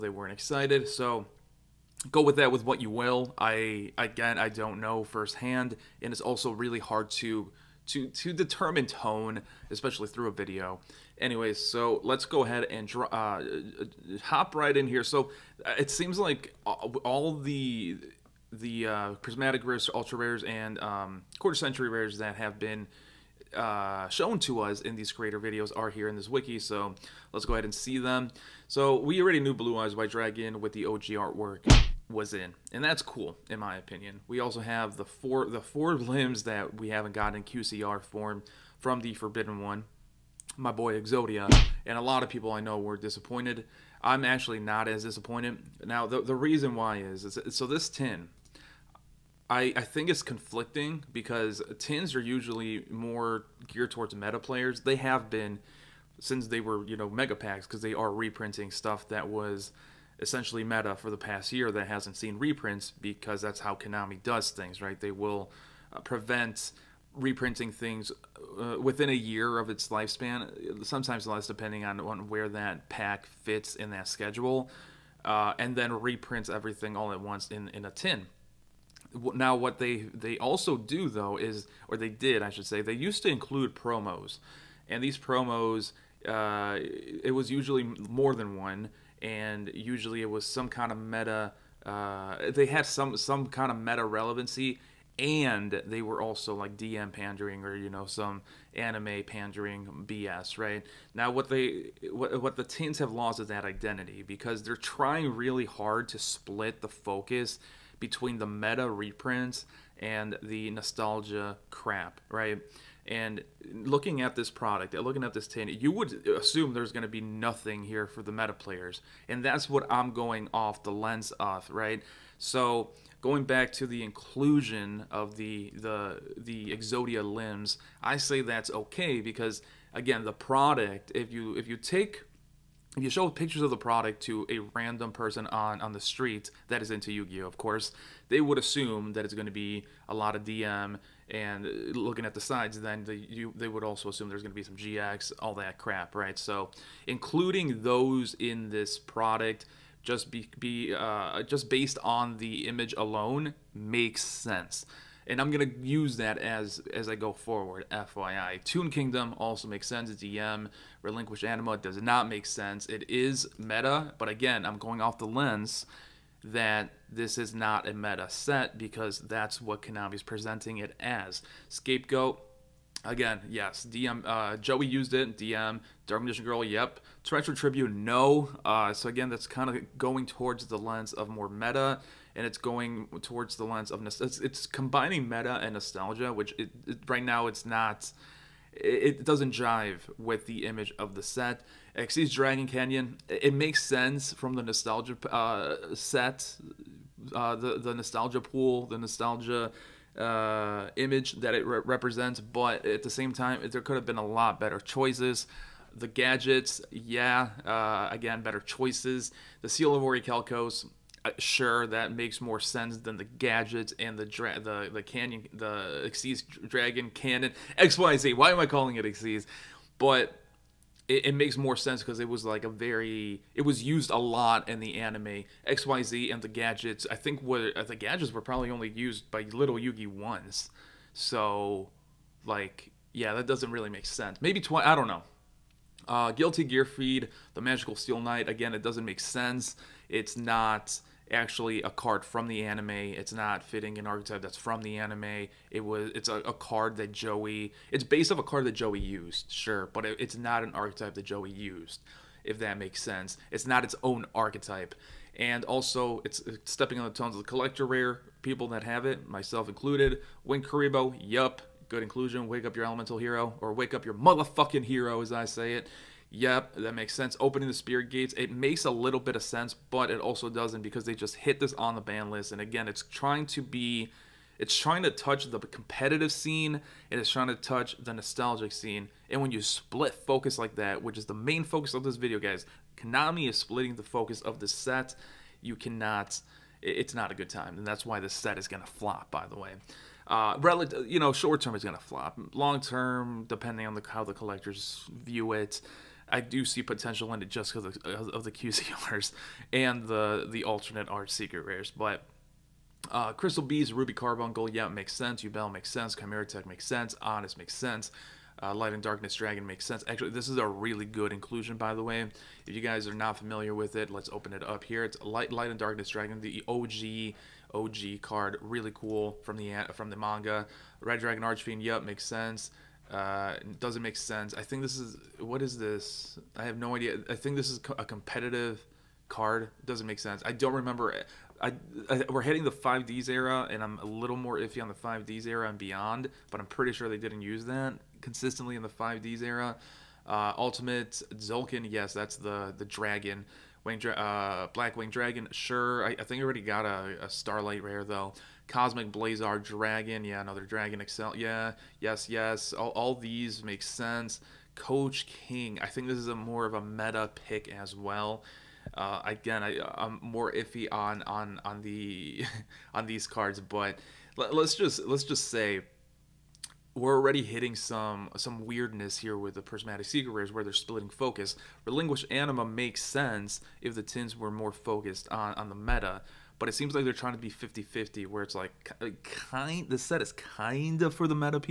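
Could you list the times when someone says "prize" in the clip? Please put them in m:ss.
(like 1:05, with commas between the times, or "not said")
not said.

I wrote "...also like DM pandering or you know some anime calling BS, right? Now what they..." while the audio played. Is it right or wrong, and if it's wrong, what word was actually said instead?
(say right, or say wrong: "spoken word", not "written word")
wrong: "pandering", not "calling".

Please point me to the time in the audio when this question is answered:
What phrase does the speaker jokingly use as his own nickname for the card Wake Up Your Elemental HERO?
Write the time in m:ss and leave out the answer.
4:23.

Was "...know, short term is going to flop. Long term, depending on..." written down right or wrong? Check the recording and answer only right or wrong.
right.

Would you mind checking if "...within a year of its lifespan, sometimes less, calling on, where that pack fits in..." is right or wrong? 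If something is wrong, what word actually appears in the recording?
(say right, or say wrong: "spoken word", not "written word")
wrong: "depending", not "calling".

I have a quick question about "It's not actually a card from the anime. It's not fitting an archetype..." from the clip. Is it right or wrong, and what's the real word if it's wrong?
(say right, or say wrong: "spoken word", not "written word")
right.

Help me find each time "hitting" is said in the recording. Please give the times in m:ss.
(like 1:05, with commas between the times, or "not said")
5:32, 6:07.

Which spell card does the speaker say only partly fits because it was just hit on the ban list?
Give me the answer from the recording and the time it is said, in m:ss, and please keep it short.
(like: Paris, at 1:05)
Opening the spirit gates, at 4:27.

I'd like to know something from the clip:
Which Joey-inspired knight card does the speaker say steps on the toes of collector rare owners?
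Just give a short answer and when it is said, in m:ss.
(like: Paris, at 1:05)
Gilti-Gearfried, The Magical Steel Knight, at 3:56.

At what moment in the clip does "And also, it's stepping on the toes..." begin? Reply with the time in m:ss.
4:15.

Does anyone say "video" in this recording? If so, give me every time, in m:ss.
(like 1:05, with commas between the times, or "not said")
0:10, 0:25, 4:42.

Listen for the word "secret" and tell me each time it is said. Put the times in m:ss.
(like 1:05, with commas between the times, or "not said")
5:01, 6:10.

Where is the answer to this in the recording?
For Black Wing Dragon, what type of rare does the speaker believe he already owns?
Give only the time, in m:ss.
5:47.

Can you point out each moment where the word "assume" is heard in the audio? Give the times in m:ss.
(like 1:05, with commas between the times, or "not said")
1:56, 2:18, 2:24.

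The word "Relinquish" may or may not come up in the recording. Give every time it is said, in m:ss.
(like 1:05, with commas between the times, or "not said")
2:41, 6:11.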